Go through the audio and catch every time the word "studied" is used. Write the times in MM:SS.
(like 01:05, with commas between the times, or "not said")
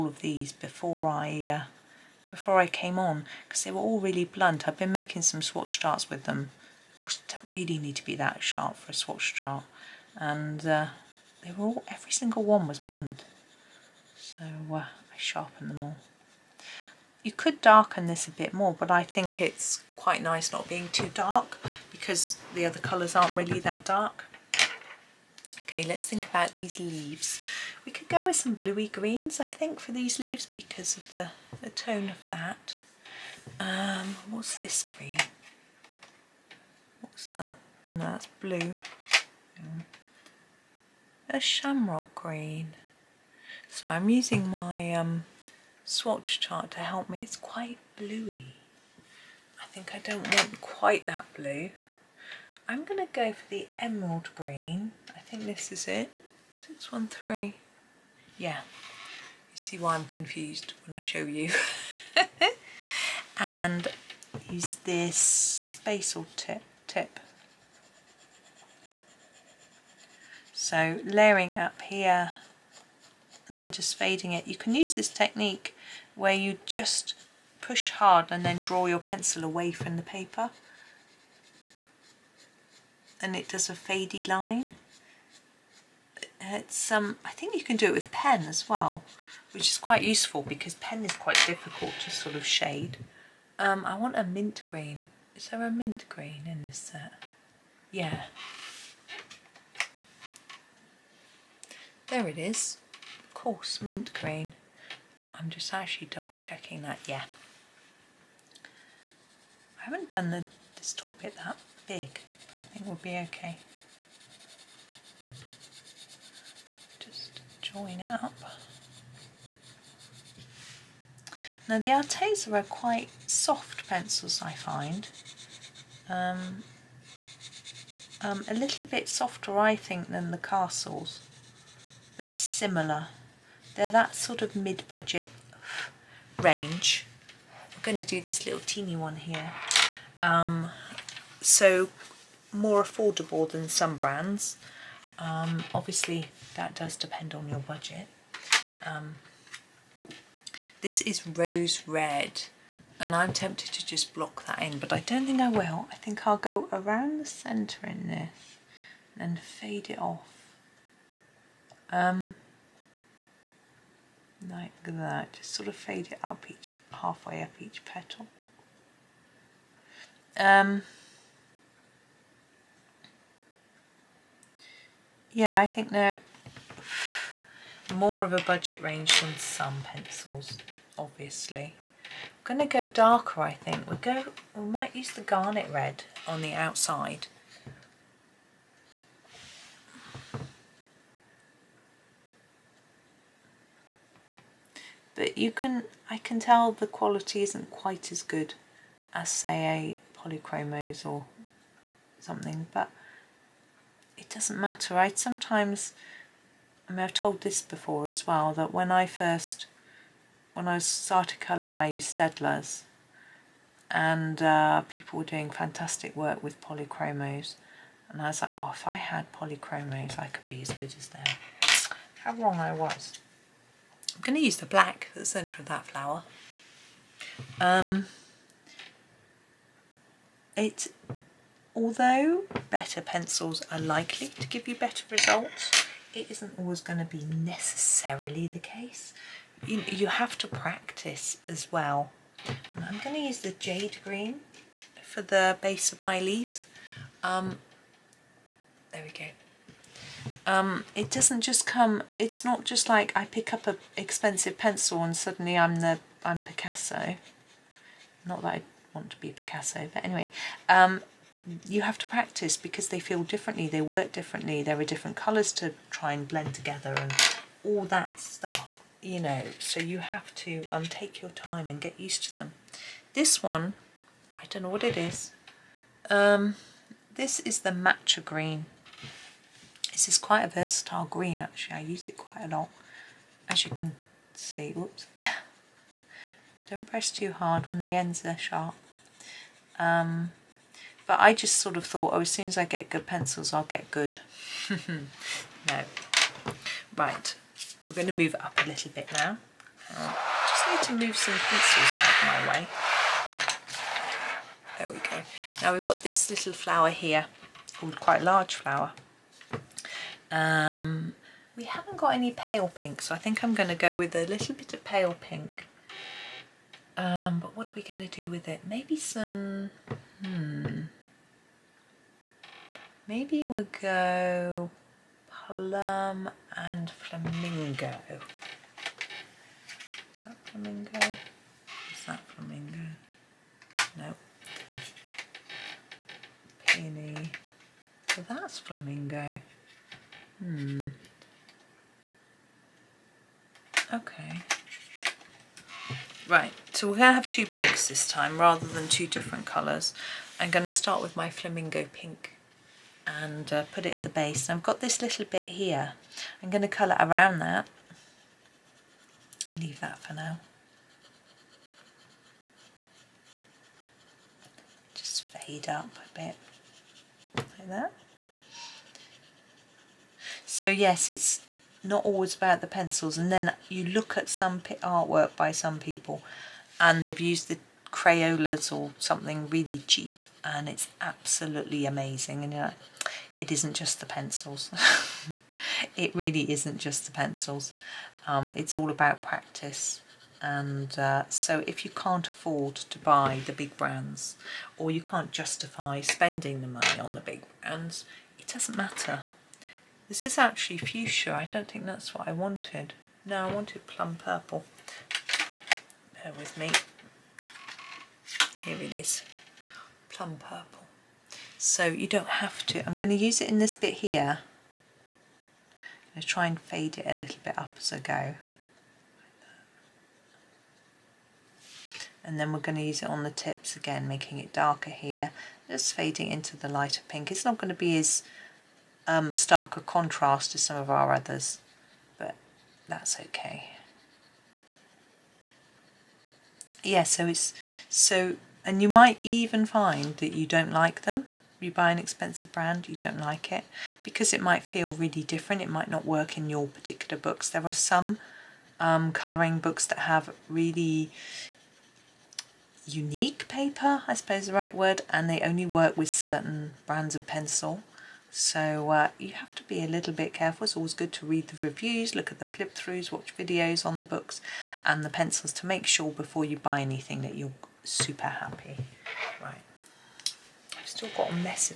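not said.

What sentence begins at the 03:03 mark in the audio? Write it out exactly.
We'll go, we might use the garnet red on the outside.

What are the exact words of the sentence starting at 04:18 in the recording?
Not that I want to be Picasso, but anyway.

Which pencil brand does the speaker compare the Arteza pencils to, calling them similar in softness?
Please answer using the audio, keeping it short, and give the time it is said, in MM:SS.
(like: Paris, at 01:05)
Castles, at 02:10.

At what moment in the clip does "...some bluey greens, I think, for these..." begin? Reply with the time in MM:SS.
00:28.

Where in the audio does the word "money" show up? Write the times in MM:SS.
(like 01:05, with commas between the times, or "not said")
06:36.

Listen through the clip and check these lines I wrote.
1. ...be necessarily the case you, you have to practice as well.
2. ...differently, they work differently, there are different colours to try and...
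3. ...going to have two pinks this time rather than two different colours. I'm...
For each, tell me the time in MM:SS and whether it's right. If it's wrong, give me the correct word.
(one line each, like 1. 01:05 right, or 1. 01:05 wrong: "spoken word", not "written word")
1. 03:57 right
2. 04:23 right
3. 05:46 right.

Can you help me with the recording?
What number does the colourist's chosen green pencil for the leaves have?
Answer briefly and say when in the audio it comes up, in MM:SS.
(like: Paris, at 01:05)
613, at 00:56.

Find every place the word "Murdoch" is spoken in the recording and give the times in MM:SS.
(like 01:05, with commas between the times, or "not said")
not said.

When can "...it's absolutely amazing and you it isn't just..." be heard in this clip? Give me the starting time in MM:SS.
06:20.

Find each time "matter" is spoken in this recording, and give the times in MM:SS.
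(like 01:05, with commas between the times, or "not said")
03:24, 06:38.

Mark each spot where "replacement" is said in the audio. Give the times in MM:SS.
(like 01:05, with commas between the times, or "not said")
not said.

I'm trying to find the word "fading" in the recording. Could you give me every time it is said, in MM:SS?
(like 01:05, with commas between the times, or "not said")
01:13, 07:05.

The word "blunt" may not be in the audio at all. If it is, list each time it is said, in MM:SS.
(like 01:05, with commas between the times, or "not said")
00:04, 00:12.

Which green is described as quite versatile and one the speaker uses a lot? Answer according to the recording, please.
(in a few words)
Matcha green.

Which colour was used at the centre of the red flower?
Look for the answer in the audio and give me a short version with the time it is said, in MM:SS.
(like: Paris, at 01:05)
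Black, at 03:44.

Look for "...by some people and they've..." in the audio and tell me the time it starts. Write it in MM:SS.
06:15.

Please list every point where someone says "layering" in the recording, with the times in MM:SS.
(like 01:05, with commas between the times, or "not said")
01:11.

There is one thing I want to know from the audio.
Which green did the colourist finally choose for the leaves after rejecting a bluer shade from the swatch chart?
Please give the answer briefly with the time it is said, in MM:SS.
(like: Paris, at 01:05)
Emerald green, at 00:53.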